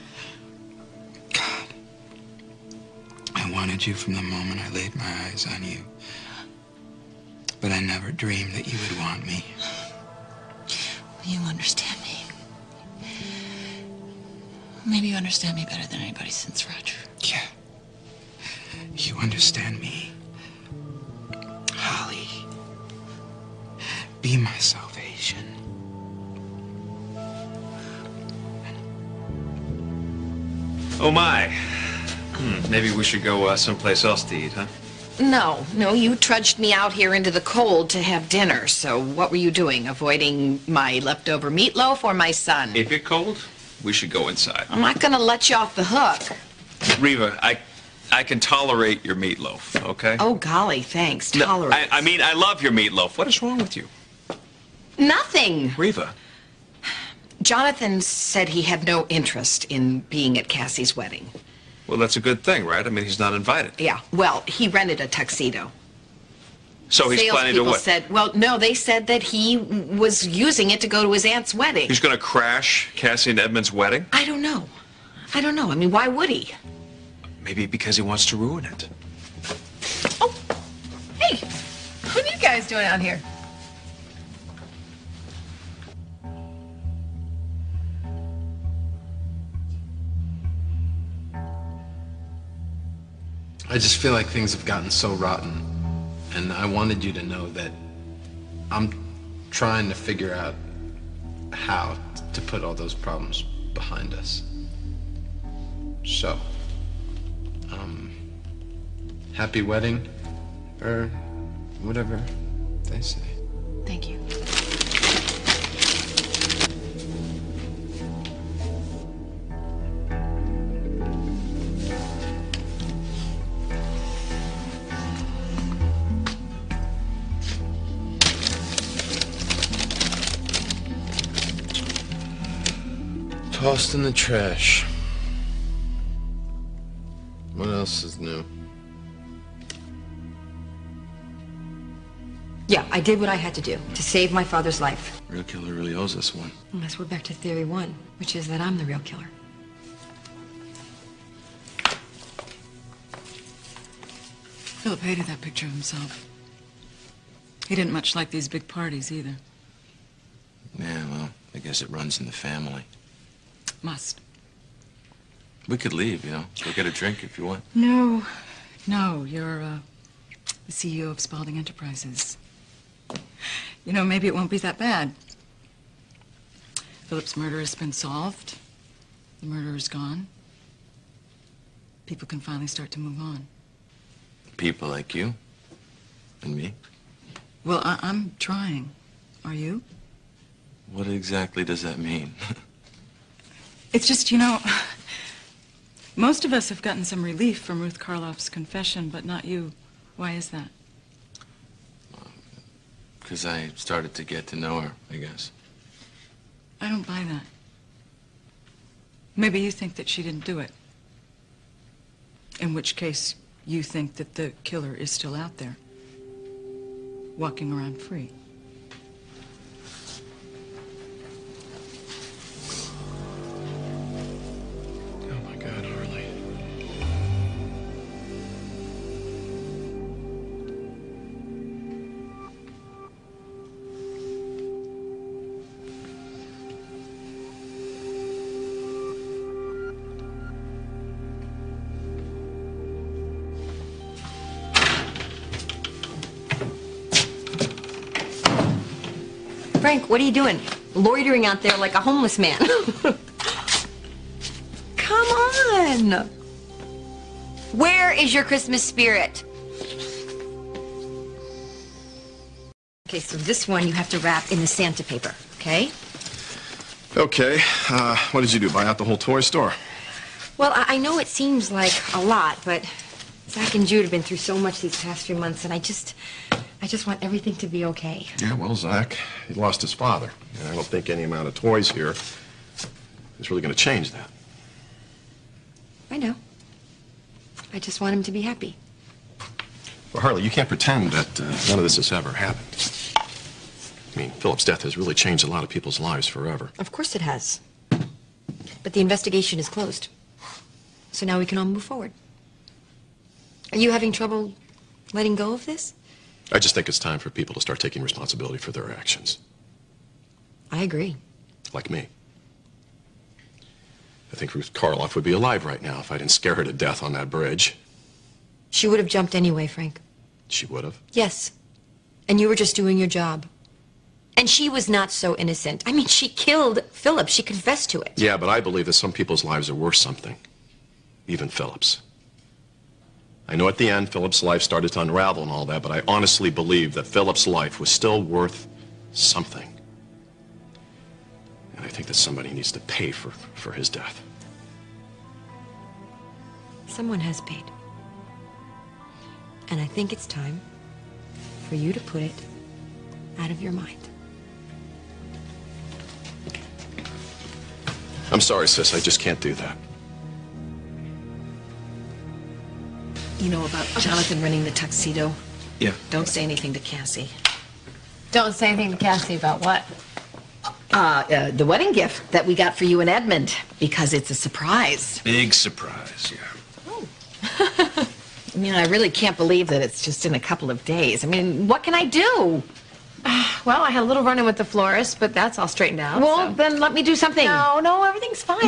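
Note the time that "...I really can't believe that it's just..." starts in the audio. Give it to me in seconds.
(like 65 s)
378 s.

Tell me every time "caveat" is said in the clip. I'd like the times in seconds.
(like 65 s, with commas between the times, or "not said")
not said.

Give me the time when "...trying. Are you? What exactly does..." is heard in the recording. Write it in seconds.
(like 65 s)
188 s.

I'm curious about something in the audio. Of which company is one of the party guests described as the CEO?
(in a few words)
Spaulding Enterprises.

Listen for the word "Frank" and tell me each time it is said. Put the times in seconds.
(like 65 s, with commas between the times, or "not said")
249 s, 319 s.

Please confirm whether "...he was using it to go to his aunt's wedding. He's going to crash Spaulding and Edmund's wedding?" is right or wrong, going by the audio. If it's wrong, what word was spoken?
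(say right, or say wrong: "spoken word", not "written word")
wrong: "Cassie", not "Spaulding".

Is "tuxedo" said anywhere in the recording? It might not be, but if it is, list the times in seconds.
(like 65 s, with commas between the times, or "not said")
65 s, 364 s.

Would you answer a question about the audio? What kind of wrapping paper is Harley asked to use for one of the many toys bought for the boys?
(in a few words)
Santa paper.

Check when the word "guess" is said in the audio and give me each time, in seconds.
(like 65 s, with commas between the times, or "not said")
161 s, 205 s.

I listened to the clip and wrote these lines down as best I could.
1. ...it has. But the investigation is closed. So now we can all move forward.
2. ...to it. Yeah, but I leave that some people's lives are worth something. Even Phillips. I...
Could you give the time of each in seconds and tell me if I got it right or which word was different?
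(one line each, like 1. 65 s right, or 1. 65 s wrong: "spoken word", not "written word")
1. 297 s right
2. 327 s wrong: "believe", not "leave".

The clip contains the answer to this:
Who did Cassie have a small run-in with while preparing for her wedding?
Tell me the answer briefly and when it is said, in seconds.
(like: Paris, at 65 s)
the florist, at 384 s.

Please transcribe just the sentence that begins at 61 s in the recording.
Well, that's a good thing, right?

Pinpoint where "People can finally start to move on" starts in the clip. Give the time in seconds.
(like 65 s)
182 s.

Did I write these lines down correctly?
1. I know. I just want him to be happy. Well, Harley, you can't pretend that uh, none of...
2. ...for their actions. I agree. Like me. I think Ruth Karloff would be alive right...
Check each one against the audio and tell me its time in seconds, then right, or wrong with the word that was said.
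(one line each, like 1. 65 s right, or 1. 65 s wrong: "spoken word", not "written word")
1. 286 s right
2. 308 s right.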